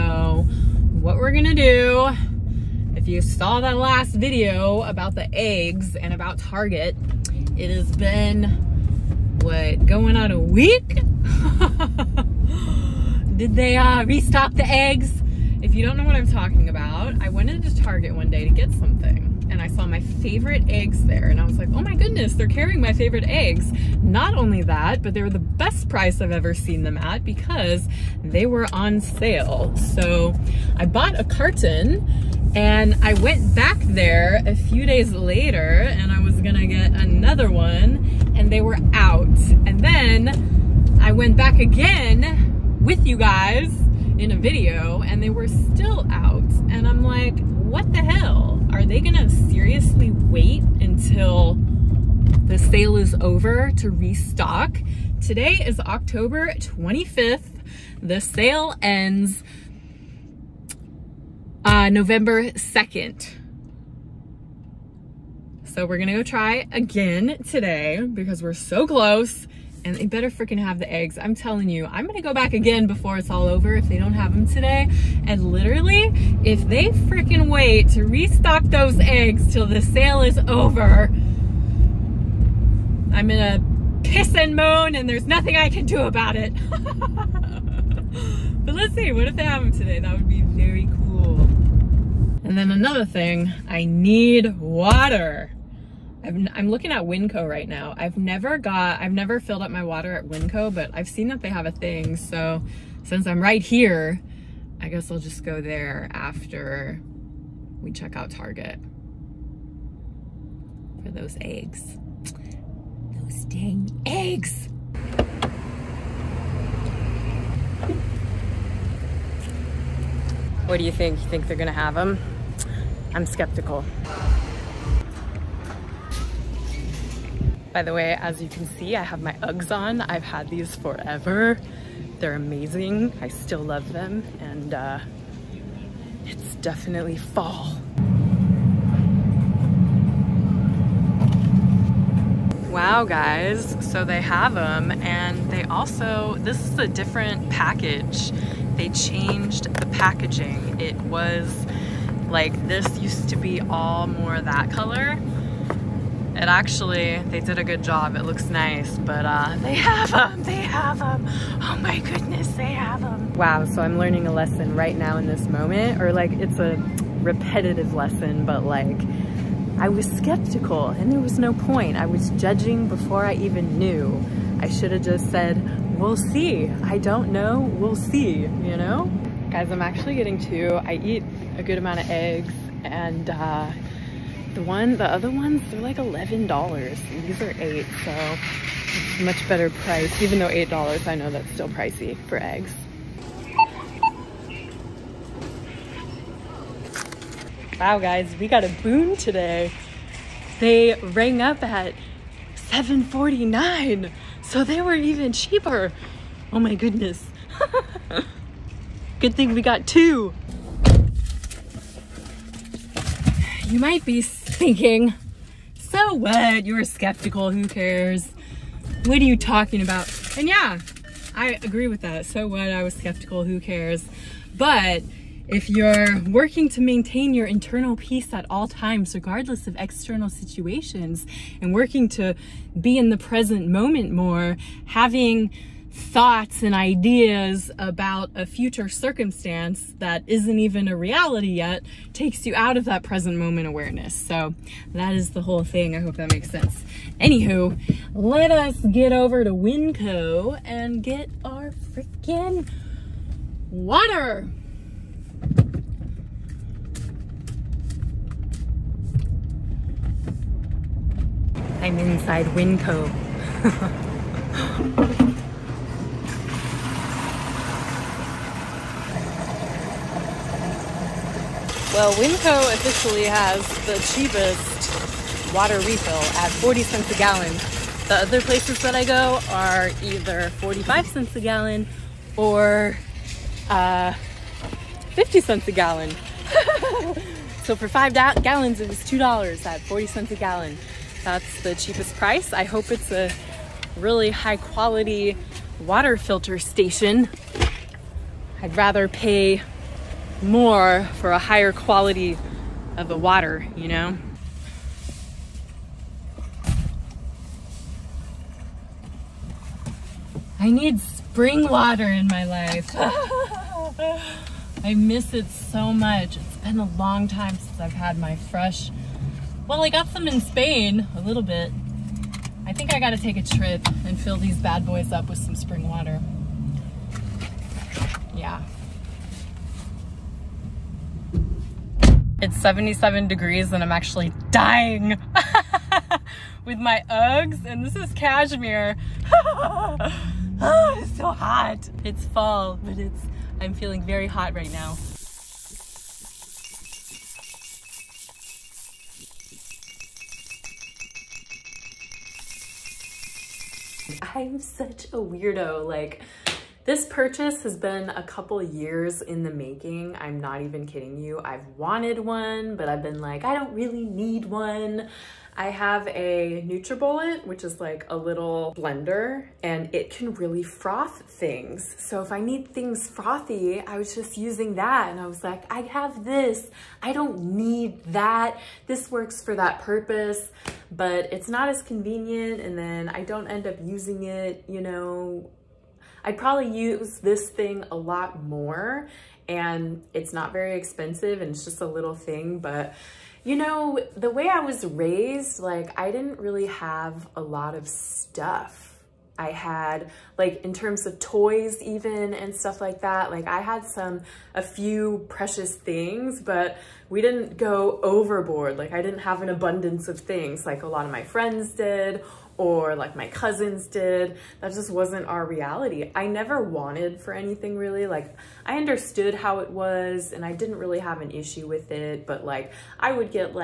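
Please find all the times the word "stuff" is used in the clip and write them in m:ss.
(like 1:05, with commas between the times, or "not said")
6:37, 6:42.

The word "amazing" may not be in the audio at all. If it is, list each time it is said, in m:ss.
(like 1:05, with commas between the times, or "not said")
2:12.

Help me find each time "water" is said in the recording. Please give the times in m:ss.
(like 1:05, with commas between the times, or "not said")
1:34, 1:39, 4:13, 4:35, 4:55, 5:03, 5:11, 5:25.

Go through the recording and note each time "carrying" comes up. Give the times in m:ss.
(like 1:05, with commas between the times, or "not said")
0:22.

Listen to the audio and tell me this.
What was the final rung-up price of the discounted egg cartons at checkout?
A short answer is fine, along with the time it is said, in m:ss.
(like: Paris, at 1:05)
$7.49, at 3:22.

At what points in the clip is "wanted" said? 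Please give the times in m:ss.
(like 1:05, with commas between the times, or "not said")
6:01, 6:56.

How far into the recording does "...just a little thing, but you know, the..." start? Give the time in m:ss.
6:31.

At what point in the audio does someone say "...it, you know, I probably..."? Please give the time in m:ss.
6:24.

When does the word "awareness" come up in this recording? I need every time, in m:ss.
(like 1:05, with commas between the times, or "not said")
4:03.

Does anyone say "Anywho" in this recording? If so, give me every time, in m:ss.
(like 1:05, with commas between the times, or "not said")
4:07.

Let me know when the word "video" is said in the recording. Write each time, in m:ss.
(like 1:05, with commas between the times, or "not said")
0:04, 0:44.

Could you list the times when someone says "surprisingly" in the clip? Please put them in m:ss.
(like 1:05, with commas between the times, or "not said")
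not said.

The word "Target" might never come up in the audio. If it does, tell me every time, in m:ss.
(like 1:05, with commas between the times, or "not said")
0:06, 0:17, 1:48.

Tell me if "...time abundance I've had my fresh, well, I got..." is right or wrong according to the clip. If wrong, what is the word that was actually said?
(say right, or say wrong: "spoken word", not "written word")
wrong: "since", not "abundance".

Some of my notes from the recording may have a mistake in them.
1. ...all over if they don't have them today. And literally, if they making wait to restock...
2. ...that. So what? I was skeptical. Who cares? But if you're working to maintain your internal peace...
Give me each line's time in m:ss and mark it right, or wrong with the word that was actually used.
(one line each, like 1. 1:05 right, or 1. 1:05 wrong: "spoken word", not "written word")
1. 1:13 wrong: "freaking", not "making"
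2. 3:42 right.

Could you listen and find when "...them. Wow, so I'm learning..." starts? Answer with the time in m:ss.
2:43.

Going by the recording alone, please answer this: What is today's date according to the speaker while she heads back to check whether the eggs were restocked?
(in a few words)
October 25th.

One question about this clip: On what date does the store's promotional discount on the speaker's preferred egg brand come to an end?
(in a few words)
November 2nd.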